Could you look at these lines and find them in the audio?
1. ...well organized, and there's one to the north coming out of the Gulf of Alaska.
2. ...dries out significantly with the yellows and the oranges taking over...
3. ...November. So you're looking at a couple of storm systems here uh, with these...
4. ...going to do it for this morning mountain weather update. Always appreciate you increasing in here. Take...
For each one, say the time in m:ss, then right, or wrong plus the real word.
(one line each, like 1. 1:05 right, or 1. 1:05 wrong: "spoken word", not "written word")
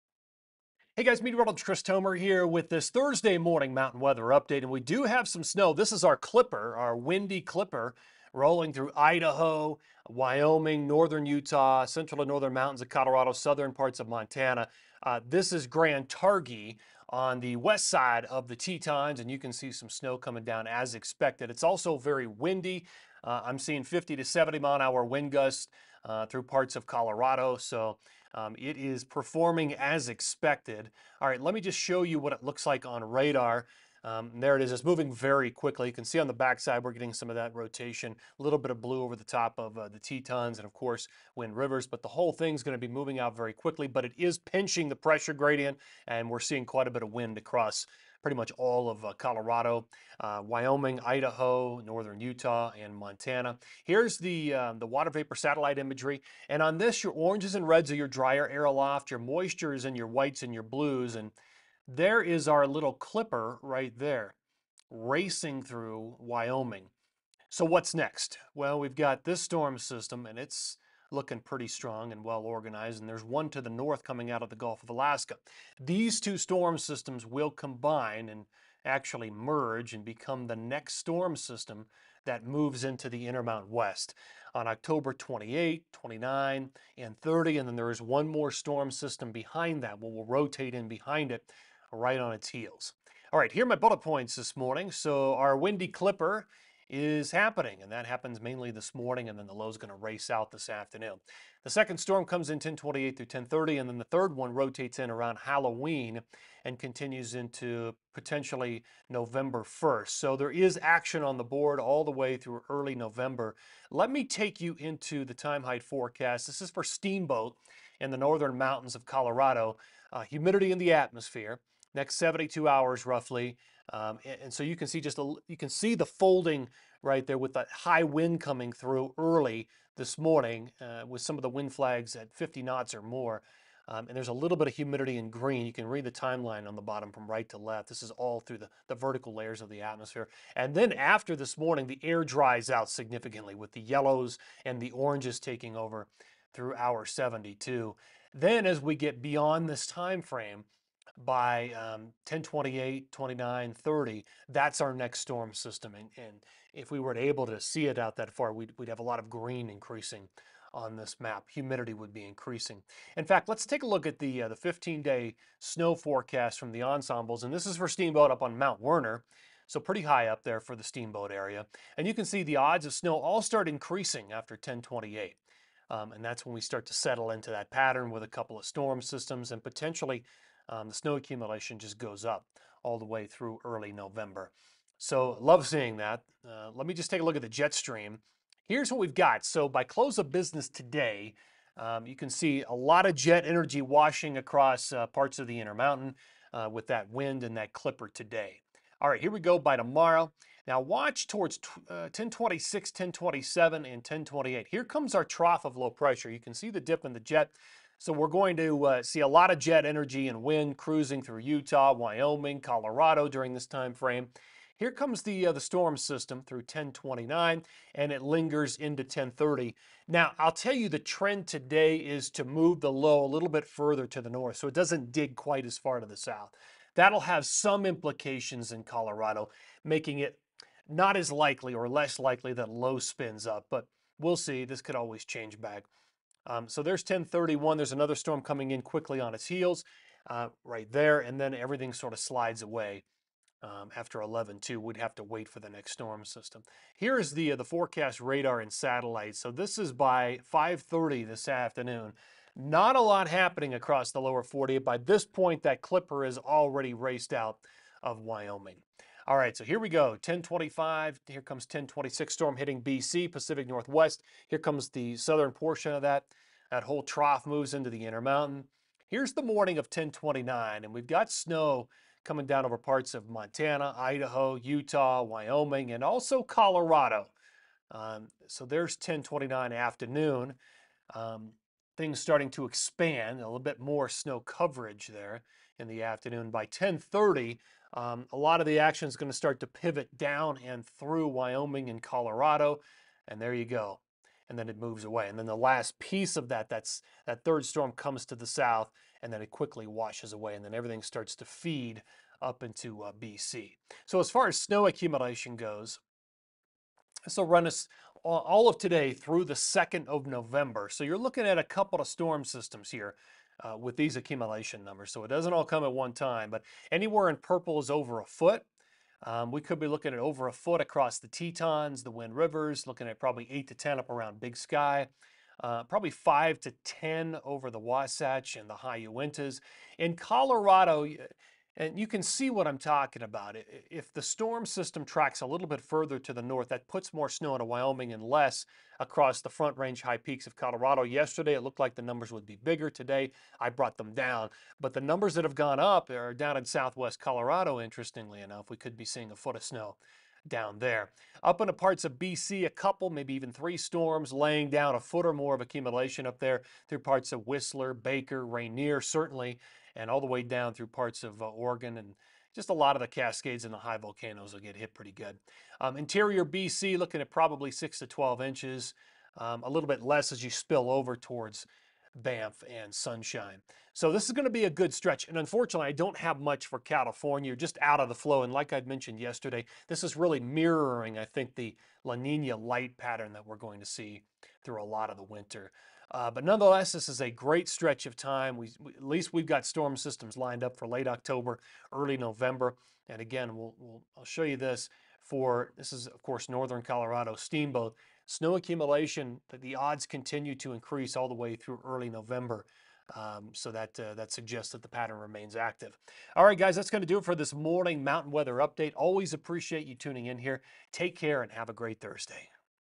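1. 1:12 right
2. 2:22 right
3. 5:10 right
4. 6:46 wrong: "tuning", not "increasing".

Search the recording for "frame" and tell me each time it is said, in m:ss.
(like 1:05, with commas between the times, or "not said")
2:30, 3:33.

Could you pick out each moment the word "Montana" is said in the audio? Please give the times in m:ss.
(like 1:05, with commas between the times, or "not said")
0:14, 0:52, 4:33.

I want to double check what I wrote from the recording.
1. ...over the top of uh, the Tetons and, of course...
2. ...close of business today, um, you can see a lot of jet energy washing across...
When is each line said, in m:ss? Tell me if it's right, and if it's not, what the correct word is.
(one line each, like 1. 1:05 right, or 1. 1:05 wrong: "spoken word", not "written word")
1. 0:39 right
2. 3:09 right.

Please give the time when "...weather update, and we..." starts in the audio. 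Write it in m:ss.
0:03.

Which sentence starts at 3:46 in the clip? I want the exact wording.
That'll have some implications in Colorado, making it not as likely or less likely that low spins up, but we'll see.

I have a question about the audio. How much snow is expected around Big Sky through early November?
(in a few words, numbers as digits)
8 to 10 inches.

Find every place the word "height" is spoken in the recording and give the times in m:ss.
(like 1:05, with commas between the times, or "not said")
1:55.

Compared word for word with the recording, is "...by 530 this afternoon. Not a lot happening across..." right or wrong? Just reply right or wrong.
right.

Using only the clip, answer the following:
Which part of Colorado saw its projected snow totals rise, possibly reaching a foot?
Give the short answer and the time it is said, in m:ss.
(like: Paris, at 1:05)
Southwest Colorado, at 5:46.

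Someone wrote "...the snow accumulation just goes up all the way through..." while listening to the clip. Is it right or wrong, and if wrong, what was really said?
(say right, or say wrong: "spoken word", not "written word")
right.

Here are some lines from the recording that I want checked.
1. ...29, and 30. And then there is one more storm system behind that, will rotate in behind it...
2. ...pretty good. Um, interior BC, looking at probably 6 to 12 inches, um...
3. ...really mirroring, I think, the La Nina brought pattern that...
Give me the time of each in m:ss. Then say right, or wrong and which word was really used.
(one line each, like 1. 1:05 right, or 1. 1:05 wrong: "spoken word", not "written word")
1. 1:25 right
2. 6:04 right
3. 6:20 wrong: "light", not "brought".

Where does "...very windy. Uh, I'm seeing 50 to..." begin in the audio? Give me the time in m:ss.
0:21.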